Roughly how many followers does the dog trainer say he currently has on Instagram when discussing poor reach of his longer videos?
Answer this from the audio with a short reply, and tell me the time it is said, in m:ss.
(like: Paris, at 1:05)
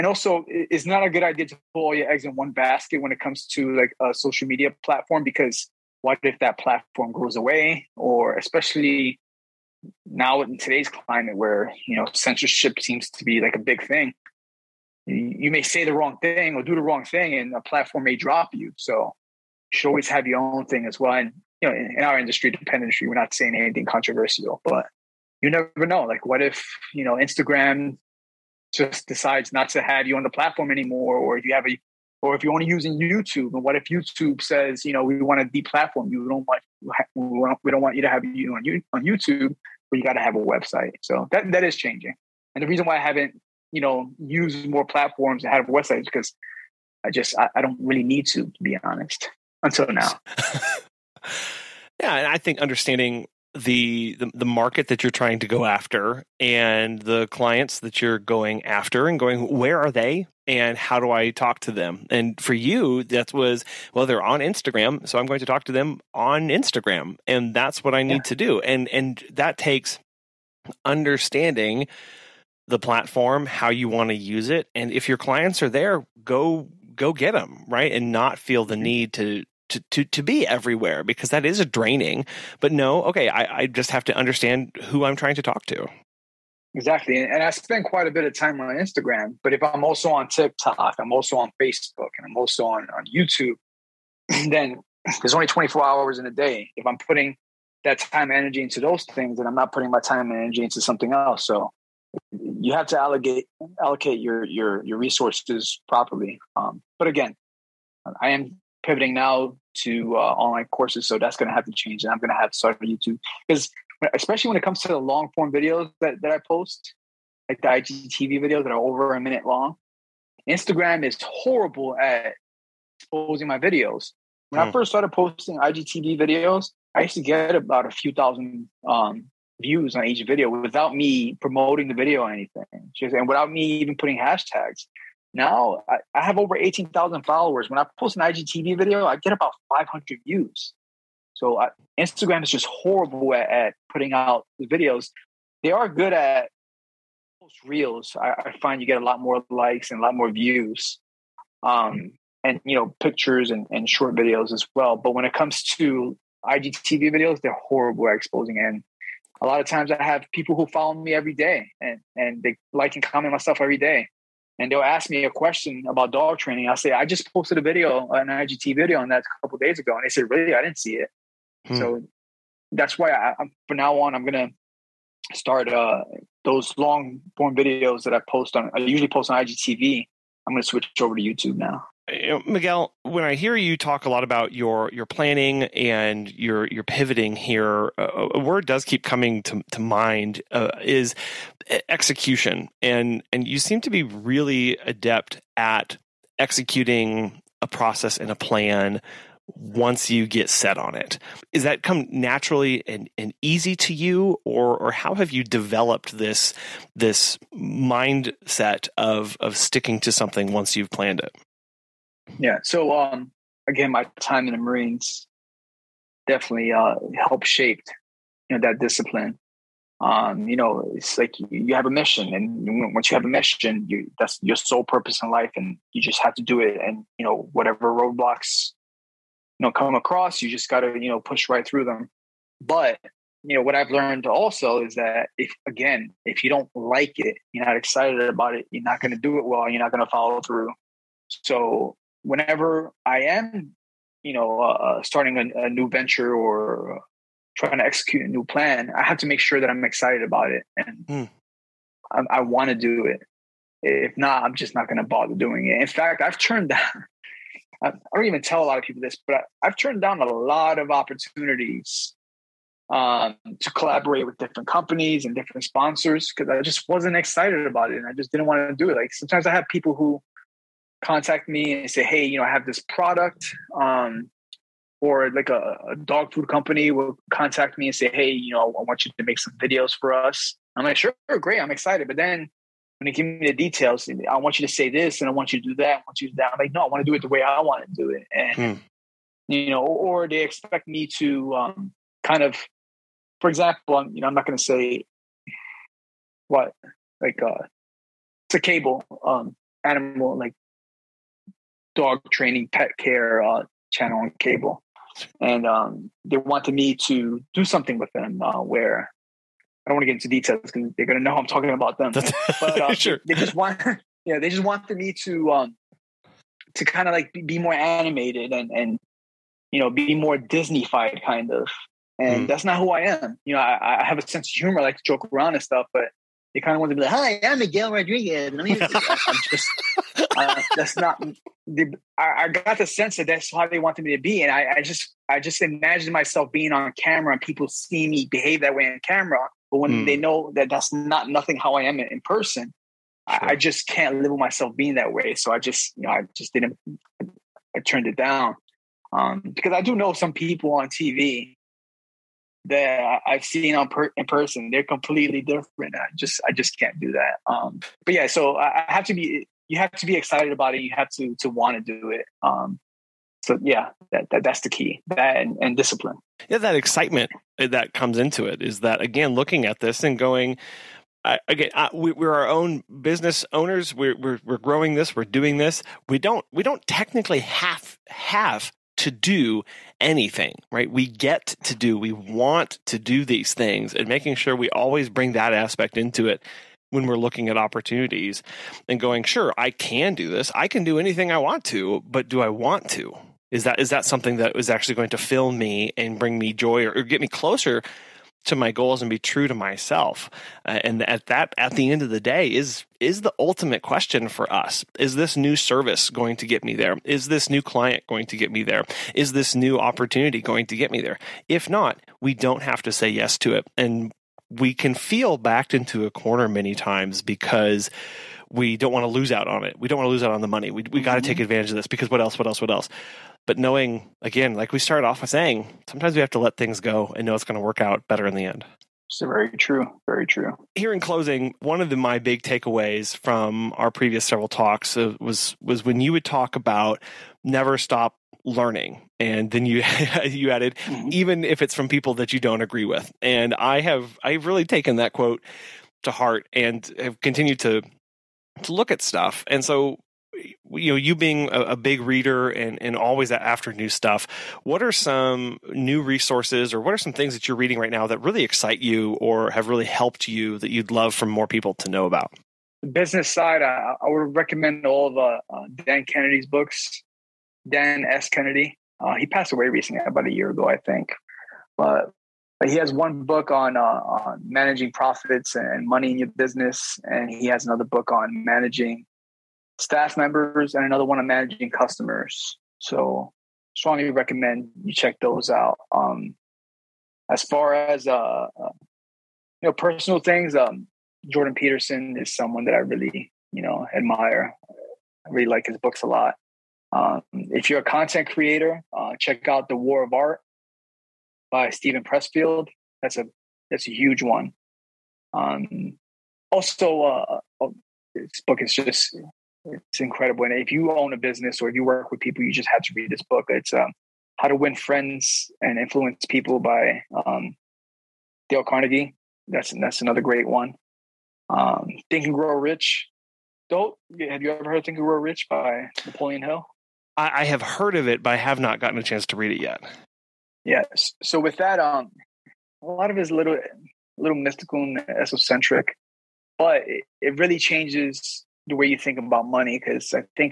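18,000, at 2:16.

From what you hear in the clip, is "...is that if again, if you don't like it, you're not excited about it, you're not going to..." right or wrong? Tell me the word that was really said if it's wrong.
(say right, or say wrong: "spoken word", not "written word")
right.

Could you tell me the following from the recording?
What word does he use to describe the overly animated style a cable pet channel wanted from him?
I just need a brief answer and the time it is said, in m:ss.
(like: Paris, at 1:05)
Disneyfied, at 5:20.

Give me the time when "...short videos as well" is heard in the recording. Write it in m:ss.
2:33.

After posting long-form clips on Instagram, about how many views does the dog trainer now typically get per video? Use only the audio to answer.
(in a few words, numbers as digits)
500.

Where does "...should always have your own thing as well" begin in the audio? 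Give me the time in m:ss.
0:19.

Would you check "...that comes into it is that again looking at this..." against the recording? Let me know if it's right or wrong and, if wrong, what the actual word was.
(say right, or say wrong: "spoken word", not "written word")
right.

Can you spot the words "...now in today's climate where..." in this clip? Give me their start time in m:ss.
0:10.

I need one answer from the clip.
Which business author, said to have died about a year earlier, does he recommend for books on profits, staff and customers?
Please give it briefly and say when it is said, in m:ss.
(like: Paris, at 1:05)
Dan Kennedy, at 7:47.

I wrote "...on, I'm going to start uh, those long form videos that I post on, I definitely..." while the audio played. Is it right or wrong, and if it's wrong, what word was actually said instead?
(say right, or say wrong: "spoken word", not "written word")
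wrong: "usually", not "definitely".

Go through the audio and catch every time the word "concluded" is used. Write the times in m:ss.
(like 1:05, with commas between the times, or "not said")
not said.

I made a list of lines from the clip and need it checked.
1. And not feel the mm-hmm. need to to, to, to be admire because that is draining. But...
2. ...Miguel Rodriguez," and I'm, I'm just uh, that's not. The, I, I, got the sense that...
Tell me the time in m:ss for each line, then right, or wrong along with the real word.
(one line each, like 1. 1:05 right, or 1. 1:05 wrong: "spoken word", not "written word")
1. 1:17 wrong: "everywhere", not "admire"
2. 5:27 right.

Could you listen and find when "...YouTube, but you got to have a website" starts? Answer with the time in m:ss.
0:39.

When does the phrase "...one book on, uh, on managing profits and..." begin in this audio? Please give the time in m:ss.
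7:52.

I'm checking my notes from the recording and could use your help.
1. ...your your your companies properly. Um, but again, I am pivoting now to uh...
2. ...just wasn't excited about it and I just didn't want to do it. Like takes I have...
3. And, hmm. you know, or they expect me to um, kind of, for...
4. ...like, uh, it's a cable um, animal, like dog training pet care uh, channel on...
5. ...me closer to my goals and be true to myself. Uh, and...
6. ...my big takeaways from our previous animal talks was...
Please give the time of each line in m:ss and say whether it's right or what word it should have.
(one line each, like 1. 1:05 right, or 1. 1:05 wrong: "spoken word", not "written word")
1. 1:44 wrong: "resources", not "companies"
2. 4:26 wrong: "sometimes", not "takes"
3. 4:48 right
4. 4:57 right
5. 6:37 right
6. 7:11 wrong: "several", not "animal".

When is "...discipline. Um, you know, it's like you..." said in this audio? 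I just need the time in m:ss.
3:38.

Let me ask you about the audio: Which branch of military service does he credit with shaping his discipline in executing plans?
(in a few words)
Marines.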